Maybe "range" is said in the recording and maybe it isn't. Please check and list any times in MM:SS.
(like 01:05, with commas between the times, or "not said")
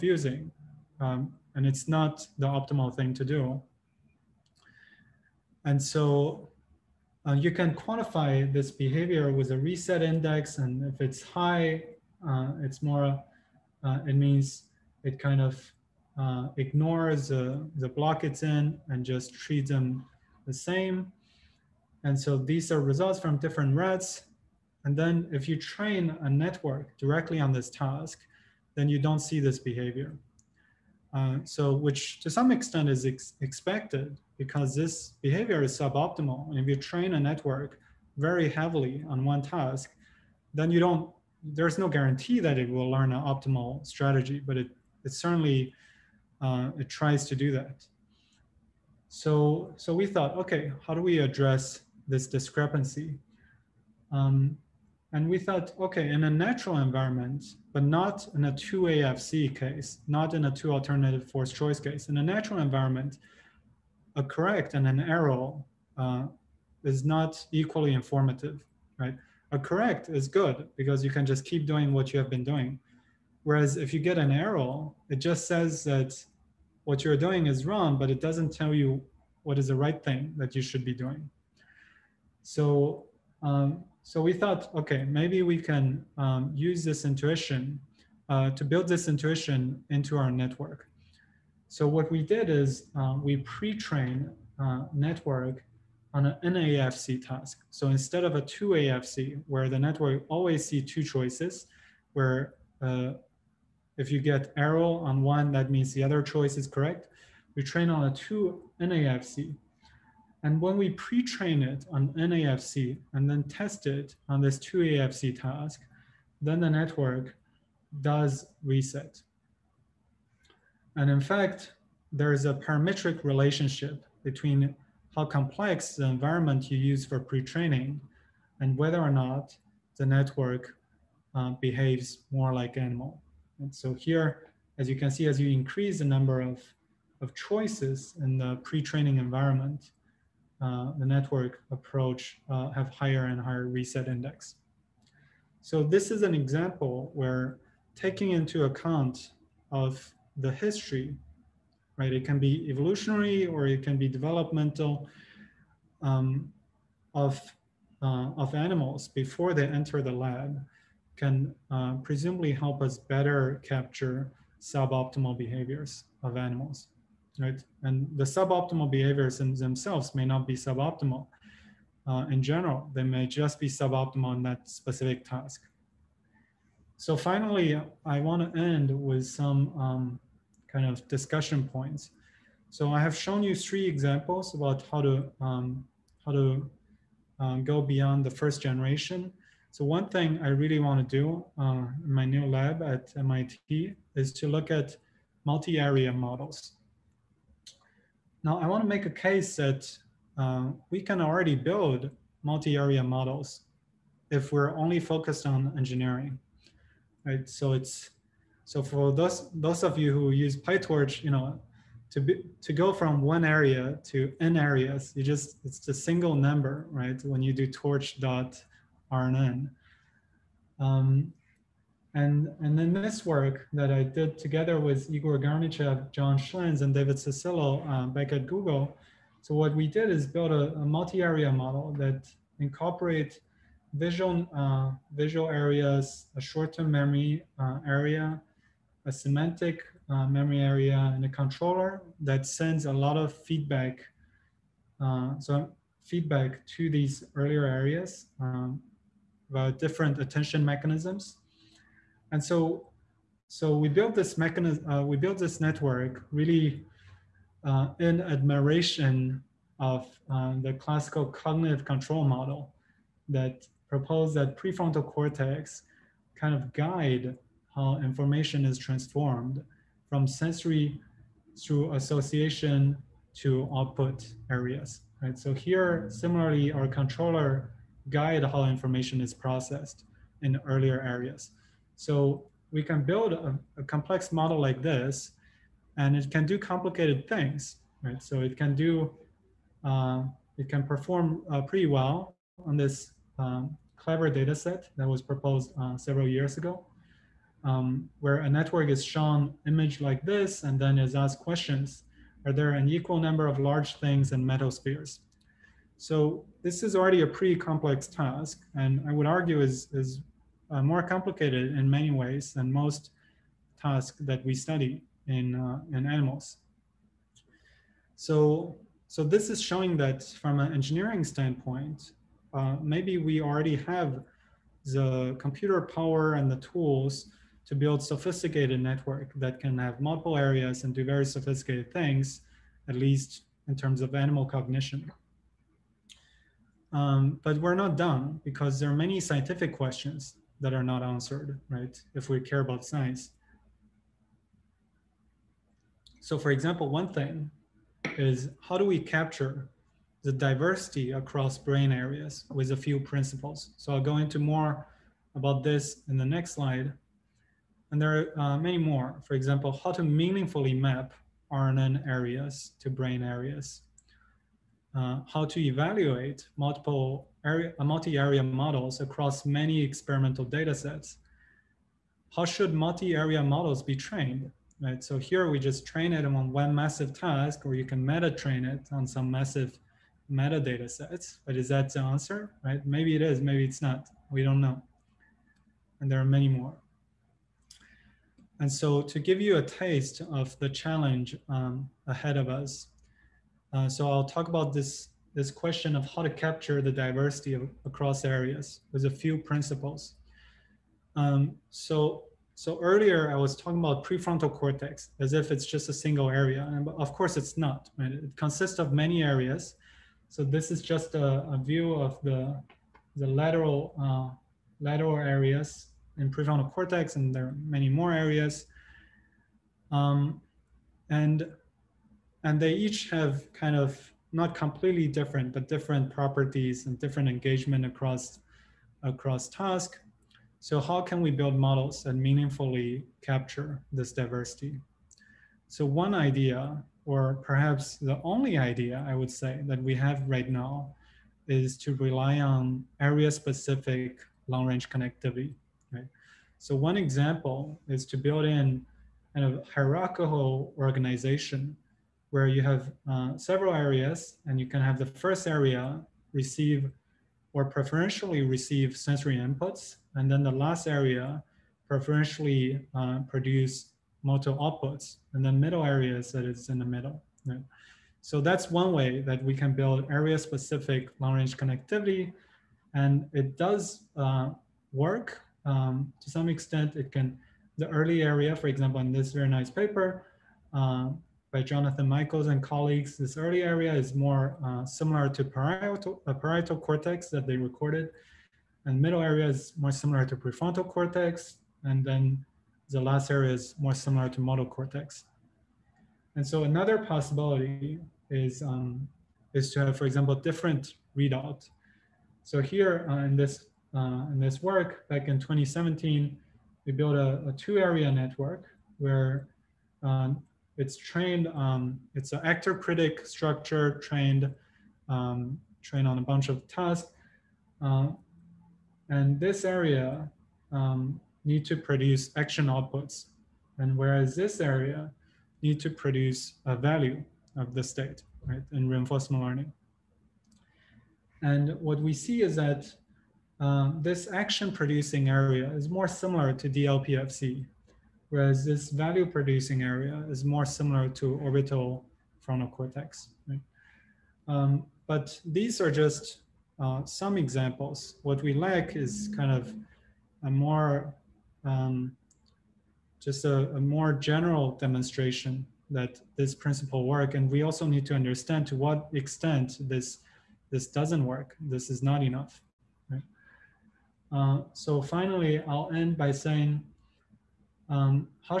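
07:24, 07:51.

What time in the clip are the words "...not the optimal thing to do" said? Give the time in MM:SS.
00:01.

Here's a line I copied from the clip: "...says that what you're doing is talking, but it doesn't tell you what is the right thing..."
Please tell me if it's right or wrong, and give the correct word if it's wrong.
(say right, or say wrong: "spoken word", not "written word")
wrong: "wrong", not "talking".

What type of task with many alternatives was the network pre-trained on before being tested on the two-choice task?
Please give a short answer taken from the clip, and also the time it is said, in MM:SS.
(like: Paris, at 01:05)
NAFC task, at 01:36.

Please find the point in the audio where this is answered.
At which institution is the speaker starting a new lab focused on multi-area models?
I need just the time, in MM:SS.
03:13.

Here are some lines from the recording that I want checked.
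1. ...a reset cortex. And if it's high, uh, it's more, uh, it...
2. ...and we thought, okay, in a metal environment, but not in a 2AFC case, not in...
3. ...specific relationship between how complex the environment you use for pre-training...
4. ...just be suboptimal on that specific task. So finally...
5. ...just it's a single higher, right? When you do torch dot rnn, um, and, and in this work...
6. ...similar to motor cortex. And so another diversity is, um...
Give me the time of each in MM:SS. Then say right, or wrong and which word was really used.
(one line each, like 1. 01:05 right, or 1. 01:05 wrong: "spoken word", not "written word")
1. 00:09 wrong: "index", not "cortex"
2. 00:55 wrong: "natural", not "metal"
3. 02:02 wrong: "parametric", not "specific"
4. 02:53 right
5. 03:35 wrong: "number", not "higher"
6. 08:13 wrong: "possibility", not "diversity".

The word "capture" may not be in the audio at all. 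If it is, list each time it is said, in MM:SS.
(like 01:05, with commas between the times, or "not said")
02:43, 05:48, 06:36, 07:13.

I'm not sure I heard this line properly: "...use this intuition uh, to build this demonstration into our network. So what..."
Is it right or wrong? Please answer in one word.
wrong.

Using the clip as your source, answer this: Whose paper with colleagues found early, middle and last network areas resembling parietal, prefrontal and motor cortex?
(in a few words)
Jonathan Michaels.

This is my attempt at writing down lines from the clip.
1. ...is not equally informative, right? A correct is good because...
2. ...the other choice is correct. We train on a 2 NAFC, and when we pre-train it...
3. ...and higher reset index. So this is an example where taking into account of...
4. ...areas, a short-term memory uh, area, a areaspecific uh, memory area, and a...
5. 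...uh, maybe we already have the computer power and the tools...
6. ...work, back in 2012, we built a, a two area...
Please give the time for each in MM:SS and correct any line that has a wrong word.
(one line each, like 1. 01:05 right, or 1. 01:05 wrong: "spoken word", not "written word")
1. 01:06 right
2. 01:45 right
3. 02:23 right
4. 03:55 wrong: "semantic", not "areaspecific"
5. 05:22 right
6. 08:24 wrong: "2017", not "2012".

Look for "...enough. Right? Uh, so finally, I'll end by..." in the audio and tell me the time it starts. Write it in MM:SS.
09:22.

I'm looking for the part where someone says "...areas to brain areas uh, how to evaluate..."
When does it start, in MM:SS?
06:02.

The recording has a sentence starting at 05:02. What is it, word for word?
Are there an equal number of large things and metal spheres?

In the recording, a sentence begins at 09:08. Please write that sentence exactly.
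What we lack is kind of a more, um, just a, a more general demonstration that this principle work.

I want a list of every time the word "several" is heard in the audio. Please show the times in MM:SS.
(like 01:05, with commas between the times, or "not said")
04:55, 07:33.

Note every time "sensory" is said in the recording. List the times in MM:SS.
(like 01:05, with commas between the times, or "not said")
04:30, 07:38.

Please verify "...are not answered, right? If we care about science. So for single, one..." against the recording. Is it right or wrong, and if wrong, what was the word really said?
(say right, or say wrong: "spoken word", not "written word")
wrong: "example", not "single".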